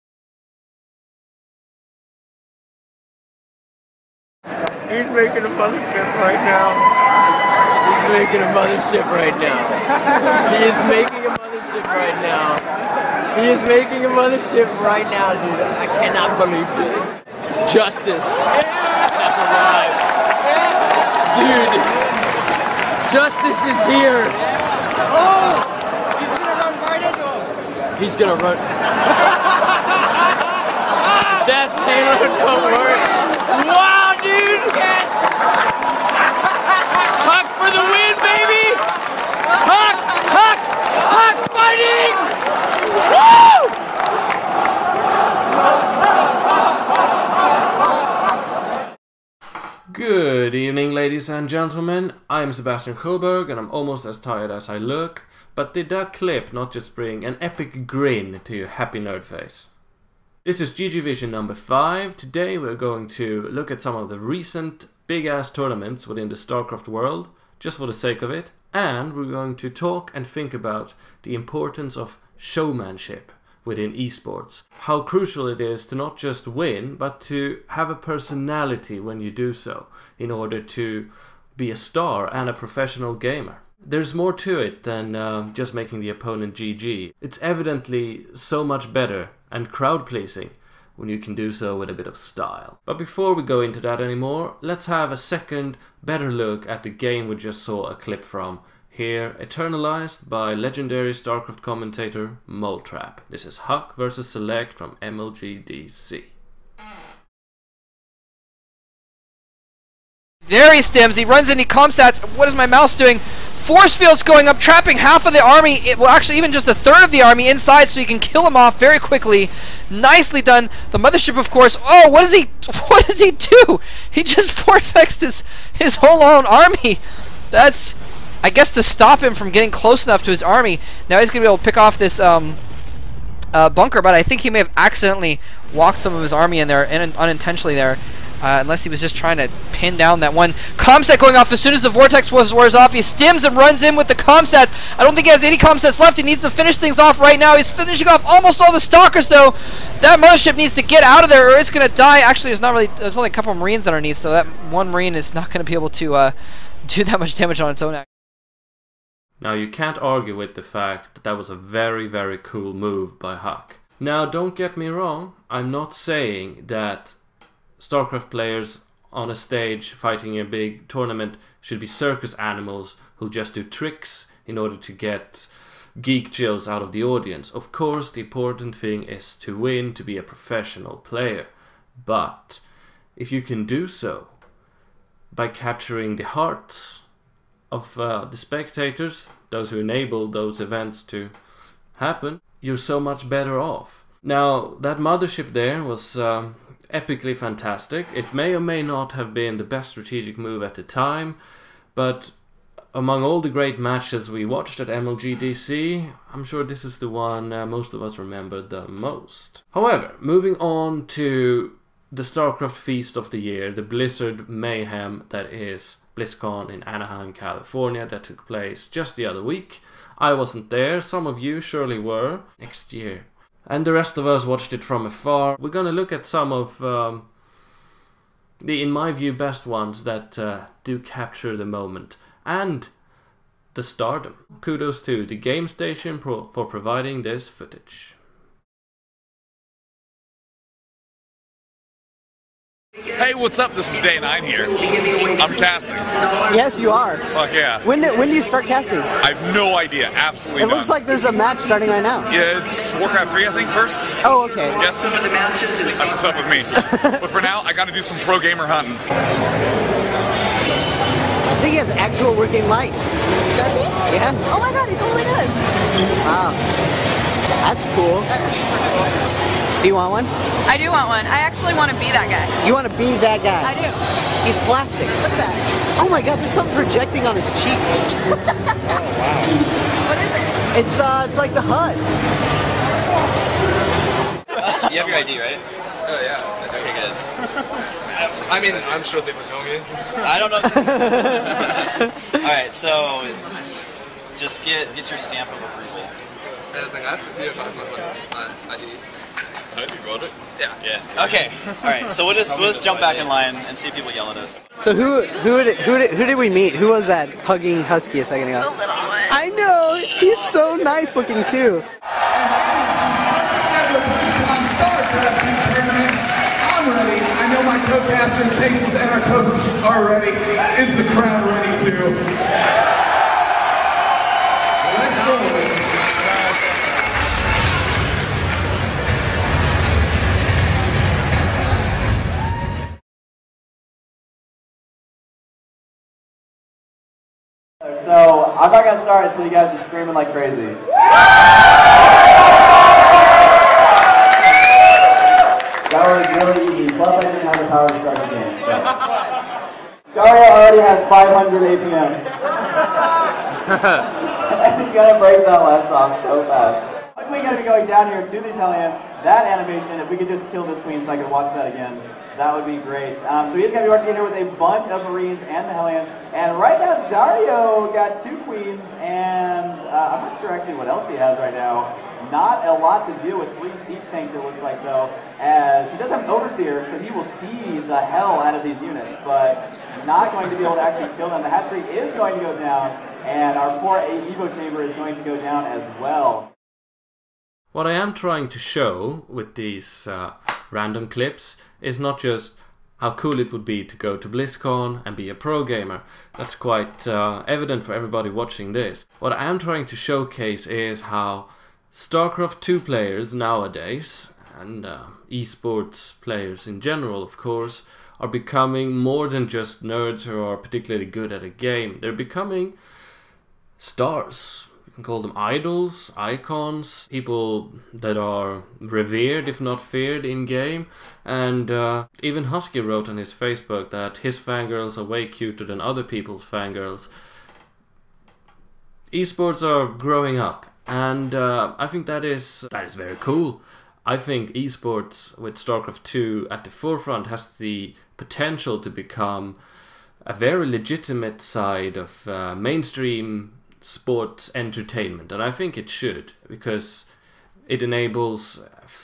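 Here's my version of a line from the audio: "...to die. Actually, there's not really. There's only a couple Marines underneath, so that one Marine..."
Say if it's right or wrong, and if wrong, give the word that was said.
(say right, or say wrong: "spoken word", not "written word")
right.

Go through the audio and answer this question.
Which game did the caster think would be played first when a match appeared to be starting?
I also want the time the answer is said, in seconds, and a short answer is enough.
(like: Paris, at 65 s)
Warcraft 3, at 252 s.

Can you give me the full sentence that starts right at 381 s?
The hatchery is going to go down, and our poor Evo Chamber is going to go down as well.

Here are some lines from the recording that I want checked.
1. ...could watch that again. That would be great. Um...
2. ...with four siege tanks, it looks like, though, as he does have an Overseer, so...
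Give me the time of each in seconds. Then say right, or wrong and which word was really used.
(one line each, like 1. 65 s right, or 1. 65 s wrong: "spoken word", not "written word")
1. 361 s right
2. 373 s wrong: "three", not "four".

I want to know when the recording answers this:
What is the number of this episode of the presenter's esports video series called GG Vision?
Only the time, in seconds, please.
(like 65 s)
60 s.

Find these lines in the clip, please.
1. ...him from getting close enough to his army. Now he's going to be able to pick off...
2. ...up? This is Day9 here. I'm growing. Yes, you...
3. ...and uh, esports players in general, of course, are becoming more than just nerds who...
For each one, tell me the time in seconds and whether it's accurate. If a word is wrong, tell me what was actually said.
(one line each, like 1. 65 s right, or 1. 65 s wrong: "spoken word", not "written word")
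1. 129 s right
2. 243 s wrong: "casting", not "growing"
3. 404 s right.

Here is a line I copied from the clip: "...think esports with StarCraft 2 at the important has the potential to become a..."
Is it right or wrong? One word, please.
wrong.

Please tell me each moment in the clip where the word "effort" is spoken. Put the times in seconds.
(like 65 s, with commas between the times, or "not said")
not said.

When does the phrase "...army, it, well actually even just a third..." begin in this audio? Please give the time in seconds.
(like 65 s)
115 s.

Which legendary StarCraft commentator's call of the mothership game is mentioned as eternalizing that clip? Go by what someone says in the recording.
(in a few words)
Moletrap.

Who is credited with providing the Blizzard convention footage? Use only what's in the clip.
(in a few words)
The Game Station Pro.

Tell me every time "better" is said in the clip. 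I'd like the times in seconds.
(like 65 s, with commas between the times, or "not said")
88 s, 96 s, 193 s.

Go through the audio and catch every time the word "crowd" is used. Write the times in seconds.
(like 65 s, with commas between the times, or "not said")
89 s, 321 s.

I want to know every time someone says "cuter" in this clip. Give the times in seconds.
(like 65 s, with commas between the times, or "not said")
425 s.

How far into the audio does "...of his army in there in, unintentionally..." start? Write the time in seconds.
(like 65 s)
136 s.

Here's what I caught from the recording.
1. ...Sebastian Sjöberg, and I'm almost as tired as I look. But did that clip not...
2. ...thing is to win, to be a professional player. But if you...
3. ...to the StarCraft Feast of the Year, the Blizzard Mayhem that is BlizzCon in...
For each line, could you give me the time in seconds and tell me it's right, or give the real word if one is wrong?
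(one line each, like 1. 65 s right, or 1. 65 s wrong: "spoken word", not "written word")
1. 52 s right
2. 178 s right
3. 211 s right.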